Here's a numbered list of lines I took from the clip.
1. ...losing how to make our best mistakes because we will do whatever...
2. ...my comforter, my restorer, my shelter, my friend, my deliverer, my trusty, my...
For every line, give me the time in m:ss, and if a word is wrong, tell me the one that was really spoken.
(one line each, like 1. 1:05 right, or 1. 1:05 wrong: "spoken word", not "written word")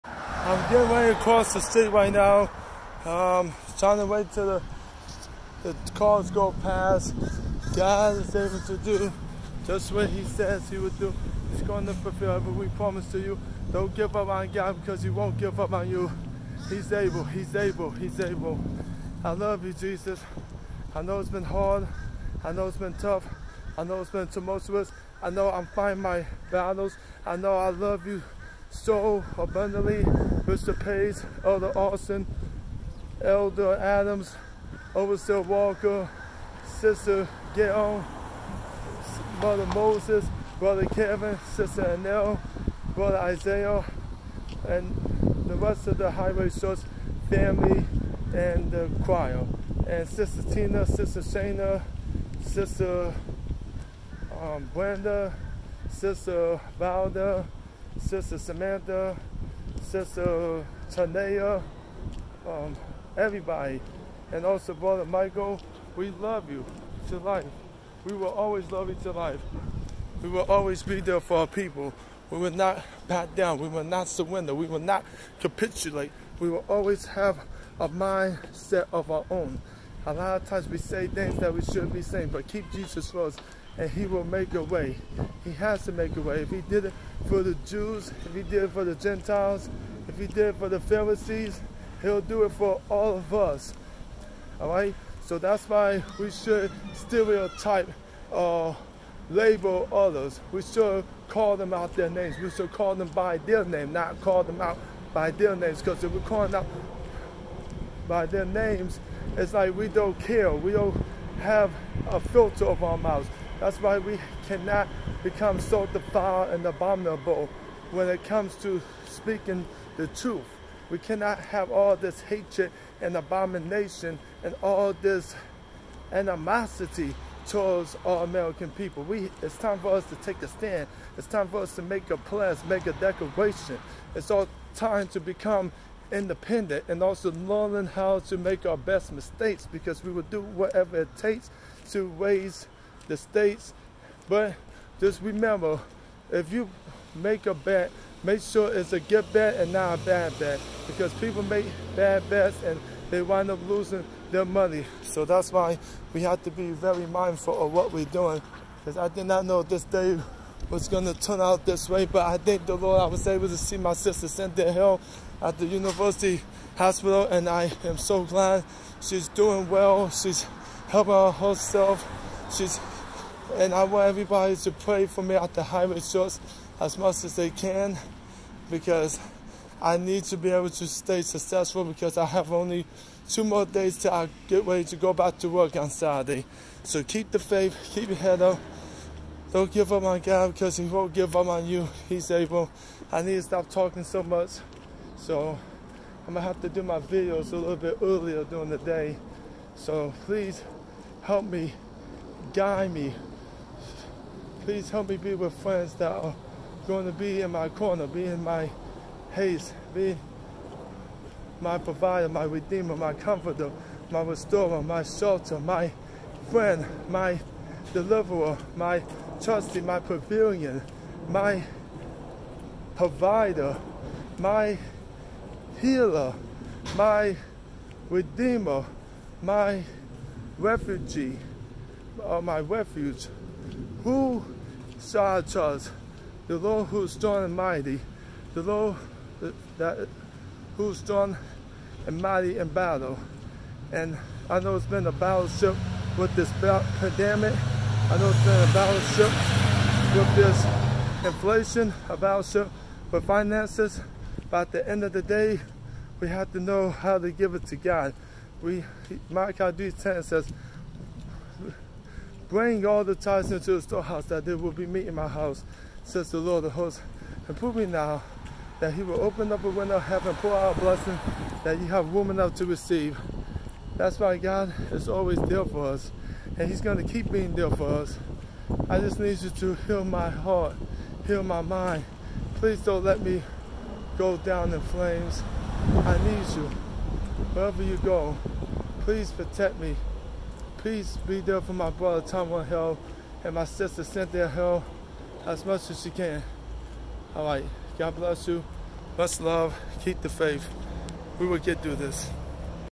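1. 2:17 wrong: "learning", not "losing"
2. 3:32 right.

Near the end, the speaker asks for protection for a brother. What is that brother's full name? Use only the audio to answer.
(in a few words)
Tommy Hill.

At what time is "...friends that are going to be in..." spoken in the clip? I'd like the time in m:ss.
3:25.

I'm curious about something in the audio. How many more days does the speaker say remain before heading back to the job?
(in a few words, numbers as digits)
2.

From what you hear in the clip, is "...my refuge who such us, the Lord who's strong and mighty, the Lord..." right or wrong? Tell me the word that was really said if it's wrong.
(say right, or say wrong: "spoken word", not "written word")
right.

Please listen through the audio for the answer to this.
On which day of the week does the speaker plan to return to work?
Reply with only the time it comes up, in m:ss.
3:05.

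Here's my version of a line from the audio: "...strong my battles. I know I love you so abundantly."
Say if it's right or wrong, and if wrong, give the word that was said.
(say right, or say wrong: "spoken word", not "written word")
wrong: "fighting", not "strong".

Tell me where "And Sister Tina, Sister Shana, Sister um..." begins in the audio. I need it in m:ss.
0:49.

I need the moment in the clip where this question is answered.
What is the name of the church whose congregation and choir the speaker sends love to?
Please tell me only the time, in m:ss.
0:46.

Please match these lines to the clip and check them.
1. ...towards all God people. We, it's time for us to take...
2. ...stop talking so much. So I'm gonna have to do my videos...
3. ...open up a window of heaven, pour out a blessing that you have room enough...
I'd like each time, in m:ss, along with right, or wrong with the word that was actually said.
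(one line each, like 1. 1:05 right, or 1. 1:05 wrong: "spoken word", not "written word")
1. 2:07 wrong: "American", not "God"
2. 3:13 right
3. 4:29 right.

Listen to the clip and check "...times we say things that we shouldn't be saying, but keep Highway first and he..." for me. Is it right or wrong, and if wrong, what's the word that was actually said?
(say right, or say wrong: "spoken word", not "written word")
wrong: "Jesus", not "Highway".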